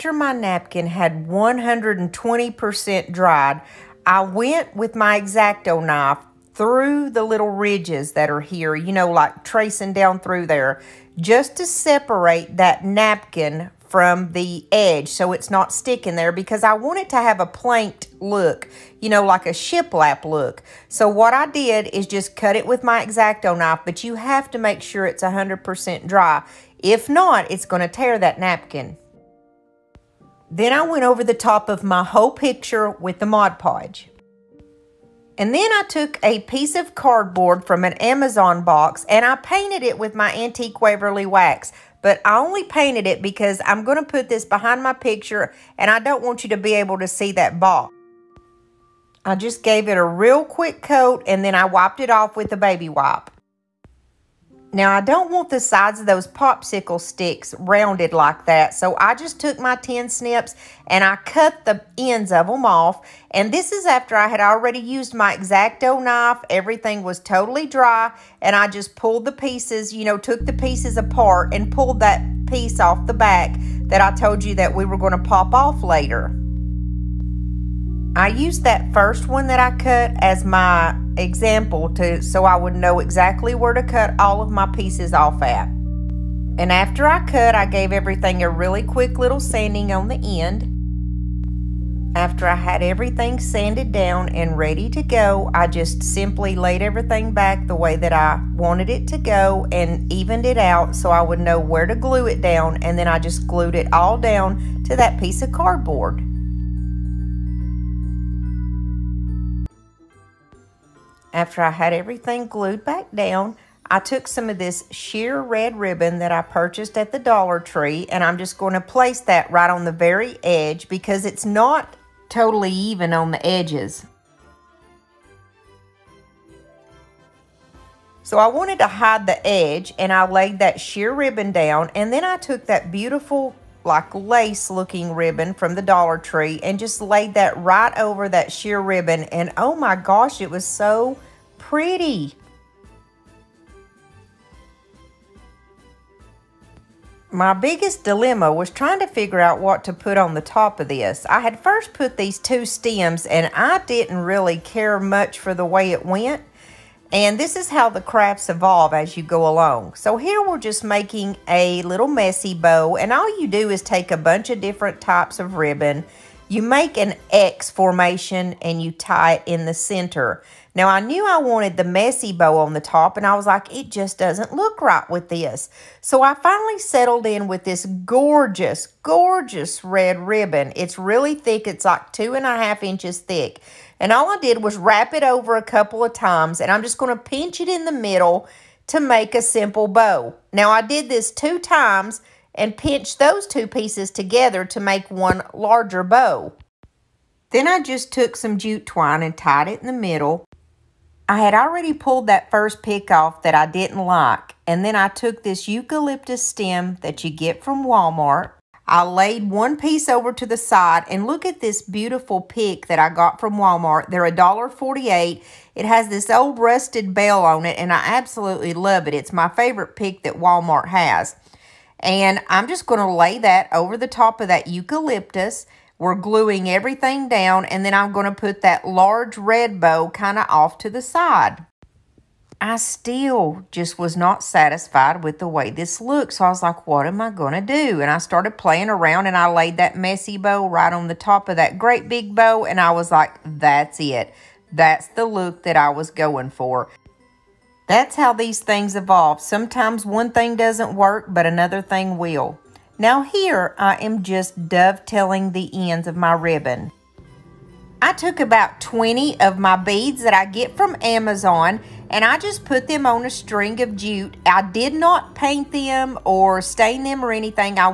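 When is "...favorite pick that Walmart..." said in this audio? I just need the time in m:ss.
3:39.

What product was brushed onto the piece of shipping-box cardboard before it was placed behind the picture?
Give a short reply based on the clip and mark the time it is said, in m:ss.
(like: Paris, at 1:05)
antique Waverly wax, at 0:40.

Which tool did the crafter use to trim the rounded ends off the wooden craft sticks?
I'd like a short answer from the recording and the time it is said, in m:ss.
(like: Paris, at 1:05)
tin snips, at 0:59.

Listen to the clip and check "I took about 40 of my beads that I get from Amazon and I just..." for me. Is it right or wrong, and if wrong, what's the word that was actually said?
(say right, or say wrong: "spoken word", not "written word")
wrong: "20", not "40".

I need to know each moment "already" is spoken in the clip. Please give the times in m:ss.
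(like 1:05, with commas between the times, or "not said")
1:04, 3:21.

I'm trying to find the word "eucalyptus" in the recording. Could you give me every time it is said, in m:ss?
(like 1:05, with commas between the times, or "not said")
3:25, 3:44.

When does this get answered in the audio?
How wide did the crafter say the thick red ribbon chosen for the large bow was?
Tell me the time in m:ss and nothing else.
3:02.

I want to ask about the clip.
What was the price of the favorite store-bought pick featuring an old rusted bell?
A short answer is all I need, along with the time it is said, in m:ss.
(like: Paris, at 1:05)
$1.48, at 3:34.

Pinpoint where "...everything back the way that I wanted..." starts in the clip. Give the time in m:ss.
1:36.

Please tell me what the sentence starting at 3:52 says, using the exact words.
I still just was not satisfied with the way this looked.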